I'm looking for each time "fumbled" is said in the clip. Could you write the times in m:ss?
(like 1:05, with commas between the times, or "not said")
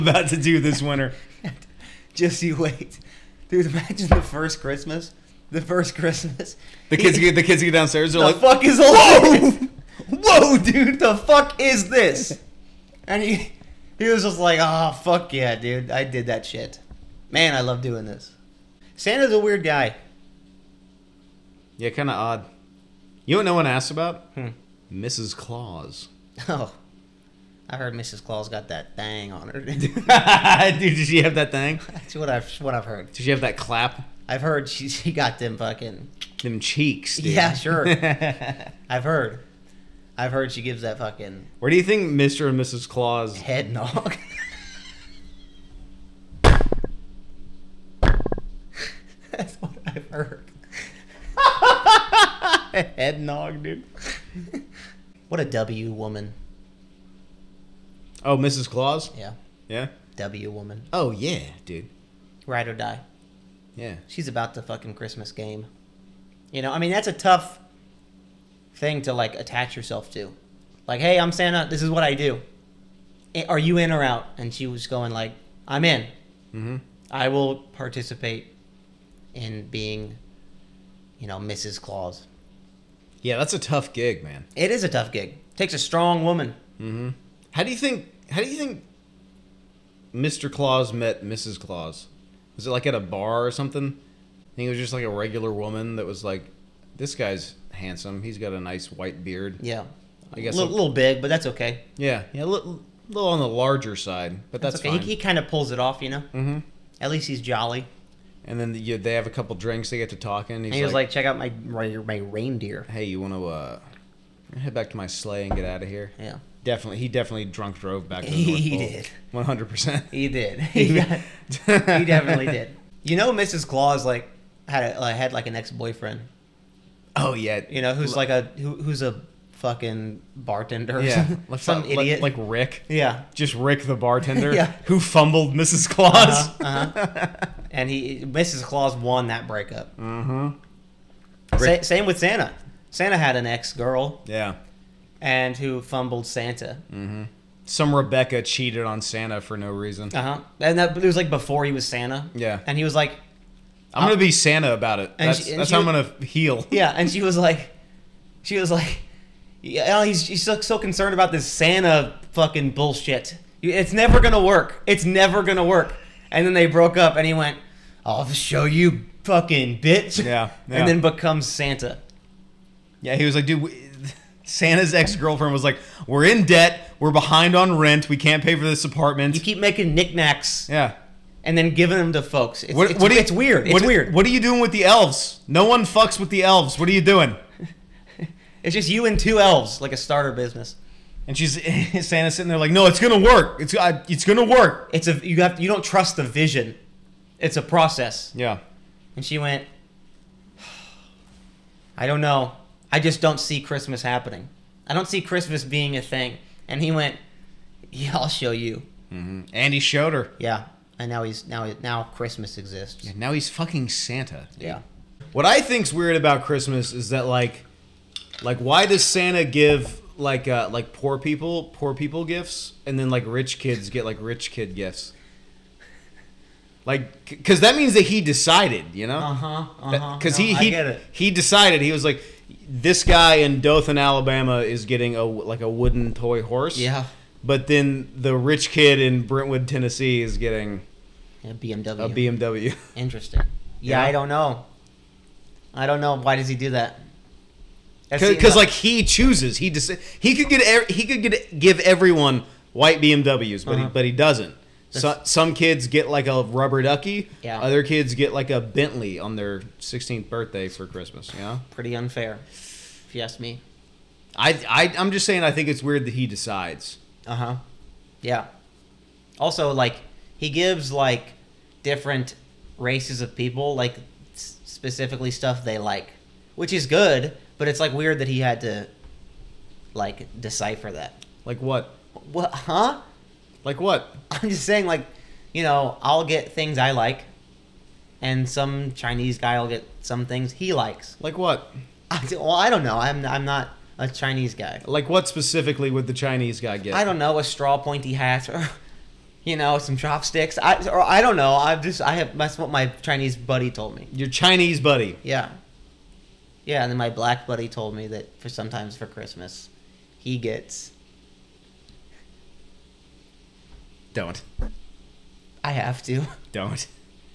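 2:14, 2:25.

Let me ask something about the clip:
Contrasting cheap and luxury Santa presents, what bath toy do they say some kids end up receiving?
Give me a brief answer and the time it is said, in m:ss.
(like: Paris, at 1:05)
rubber ducky, at 4:16.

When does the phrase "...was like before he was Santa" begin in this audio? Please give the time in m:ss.
2:31.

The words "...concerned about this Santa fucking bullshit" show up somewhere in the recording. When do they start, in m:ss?
2:40.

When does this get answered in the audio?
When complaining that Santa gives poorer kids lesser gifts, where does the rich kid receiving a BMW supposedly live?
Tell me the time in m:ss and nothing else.
3:59.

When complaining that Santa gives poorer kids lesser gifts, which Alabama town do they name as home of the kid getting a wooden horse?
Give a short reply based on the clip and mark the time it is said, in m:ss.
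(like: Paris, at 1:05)
Dothan, at 3:53.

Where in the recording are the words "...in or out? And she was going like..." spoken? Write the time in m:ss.
1:13.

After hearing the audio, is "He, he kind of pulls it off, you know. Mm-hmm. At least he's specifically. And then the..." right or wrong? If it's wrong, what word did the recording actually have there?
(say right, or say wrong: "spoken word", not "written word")
wrong: "jolly", not "specifically".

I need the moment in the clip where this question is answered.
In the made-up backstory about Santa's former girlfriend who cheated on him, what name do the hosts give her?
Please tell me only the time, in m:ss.
2:27.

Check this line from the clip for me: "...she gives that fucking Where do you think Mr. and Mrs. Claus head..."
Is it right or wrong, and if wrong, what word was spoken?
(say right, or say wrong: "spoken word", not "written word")
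right.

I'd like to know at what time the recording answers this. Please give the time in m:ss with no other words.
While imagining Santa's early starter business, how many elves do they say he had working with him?
3:09.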